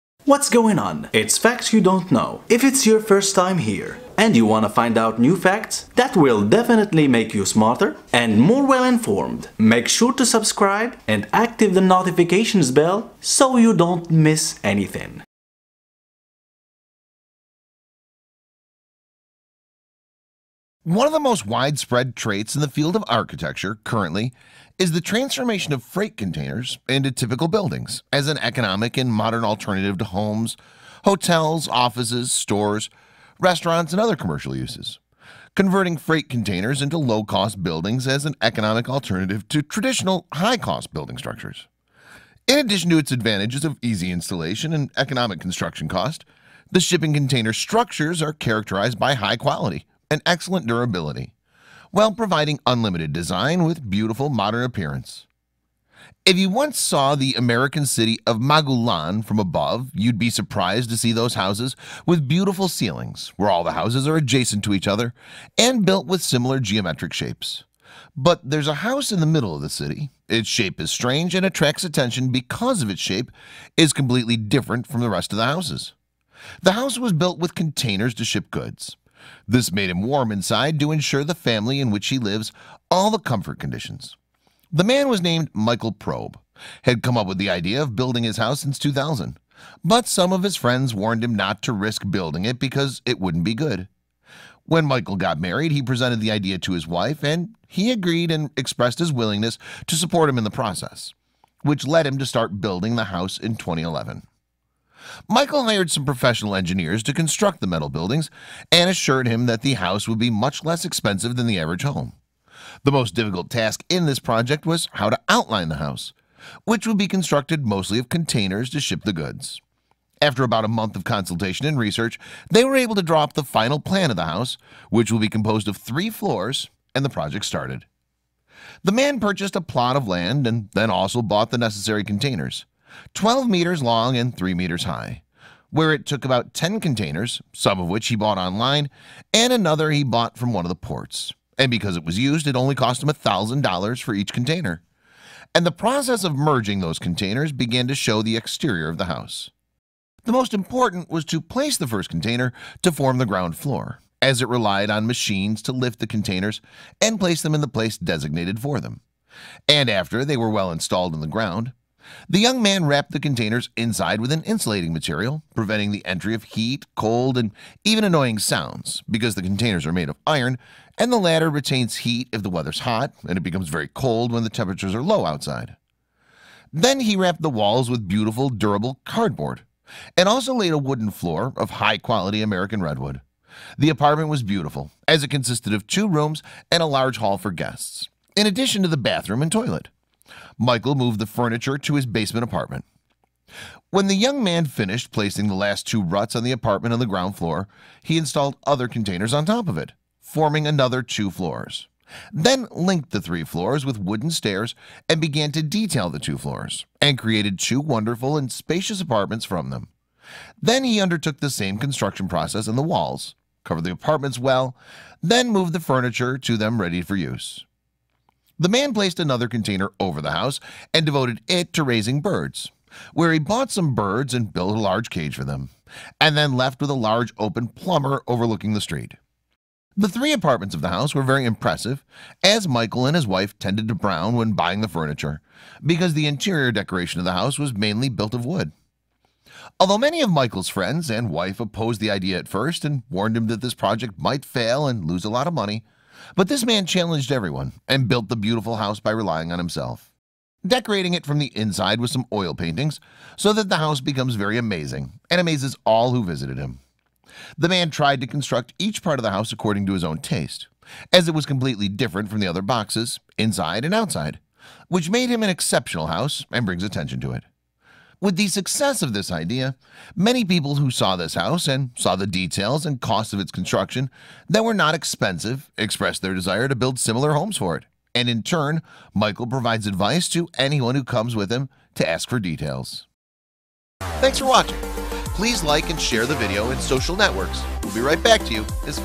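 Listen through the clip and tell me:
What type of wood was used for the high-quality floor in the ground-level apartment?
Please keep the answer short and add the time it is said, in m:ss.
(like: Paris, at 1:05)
American redwood, at 3:02.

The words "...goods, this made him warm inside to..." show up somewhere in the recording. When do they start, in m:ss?
1:18.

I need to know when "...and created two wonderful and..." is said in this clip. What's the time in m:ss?
3:27.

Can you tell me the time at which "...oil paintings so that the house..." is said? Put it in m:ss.
4:12.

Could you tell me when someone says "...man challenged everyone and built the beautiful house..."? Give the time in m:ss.
4:06.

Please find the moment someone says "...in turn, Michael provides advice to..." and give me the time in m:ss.
4:38.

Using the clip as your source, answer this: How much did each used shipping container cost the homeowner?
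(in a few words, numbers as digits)
$1,000.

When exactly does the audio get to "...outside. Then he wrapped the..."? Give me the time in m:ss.
2:55.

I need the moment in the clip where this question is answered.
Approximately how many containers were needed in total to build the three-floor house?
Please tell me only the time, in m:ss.
2:16.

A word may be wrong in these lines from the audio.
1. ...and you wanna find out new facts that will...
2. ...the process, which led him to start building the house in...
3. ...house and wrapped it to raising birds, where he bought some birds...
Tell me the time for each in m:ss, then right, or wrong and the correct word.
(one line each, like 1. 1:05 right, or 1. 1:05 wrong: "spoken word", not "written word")
1. 0:04 right
2. 1:40 right
3. 3:40 wrong: "devoted", not "wrapped".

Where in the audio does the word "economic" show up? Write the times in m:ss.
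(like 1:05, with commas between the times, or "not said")
0:28, 0:38, 0:44.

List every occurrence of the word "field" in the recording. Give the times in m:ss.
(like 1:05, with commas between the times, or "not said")
0:22.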